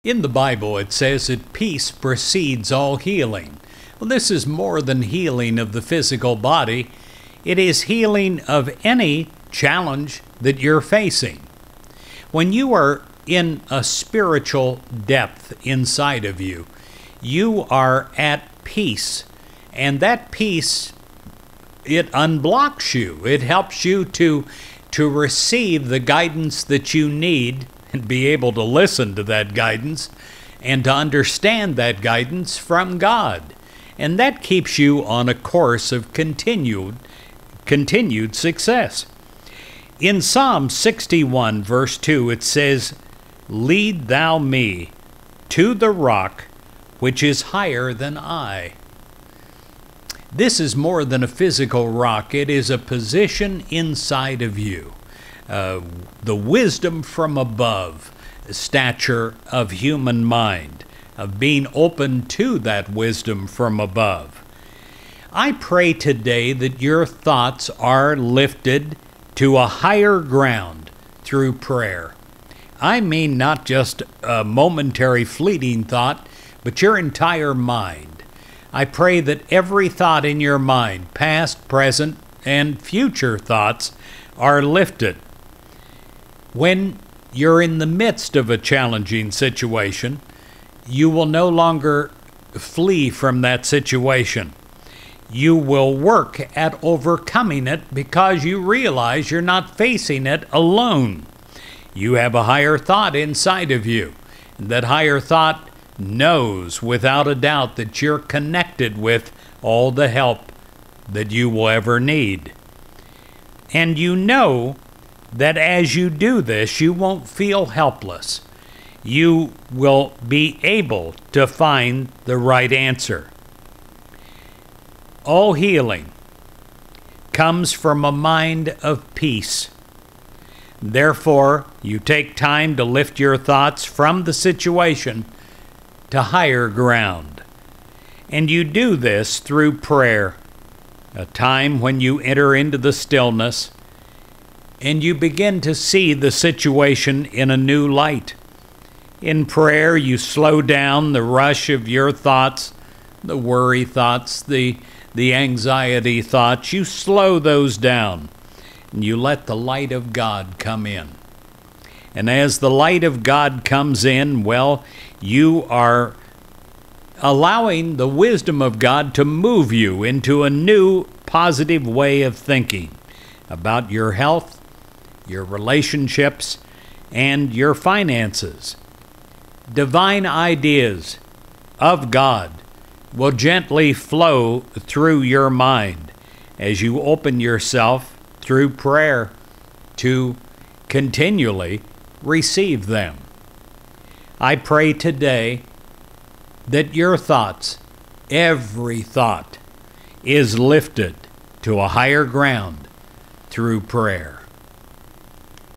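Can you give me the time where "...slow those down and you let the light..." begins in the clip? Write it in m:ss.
2:36.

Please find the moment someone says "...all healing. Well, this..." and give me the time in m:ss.
0:02.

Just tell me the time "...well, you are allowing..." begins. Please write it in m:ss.
2:44.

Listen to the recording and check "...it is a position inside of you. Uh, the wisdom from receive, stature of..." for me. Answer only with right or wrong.
wrong.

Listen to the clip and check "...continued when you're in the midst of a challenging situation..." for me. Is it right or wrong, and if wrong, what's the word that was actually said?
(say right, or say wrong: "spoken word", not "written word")
wrong: "lifted", not "continued".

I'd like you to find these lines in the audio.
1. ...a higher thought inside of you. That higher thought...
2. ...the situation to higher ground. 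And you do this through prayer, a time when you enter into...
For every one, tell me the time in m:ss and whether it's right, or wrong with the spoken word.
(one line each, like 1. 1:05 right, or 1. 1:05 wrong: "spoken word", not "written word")
1. 1:42 right
2. 2:14 right.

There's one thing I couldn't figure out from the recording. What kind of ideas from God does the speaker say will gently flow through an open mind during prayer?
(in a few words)
Divine ideas.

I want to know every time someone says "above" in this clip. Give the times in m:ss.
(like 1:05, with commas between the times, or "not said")
0:57, 1:03.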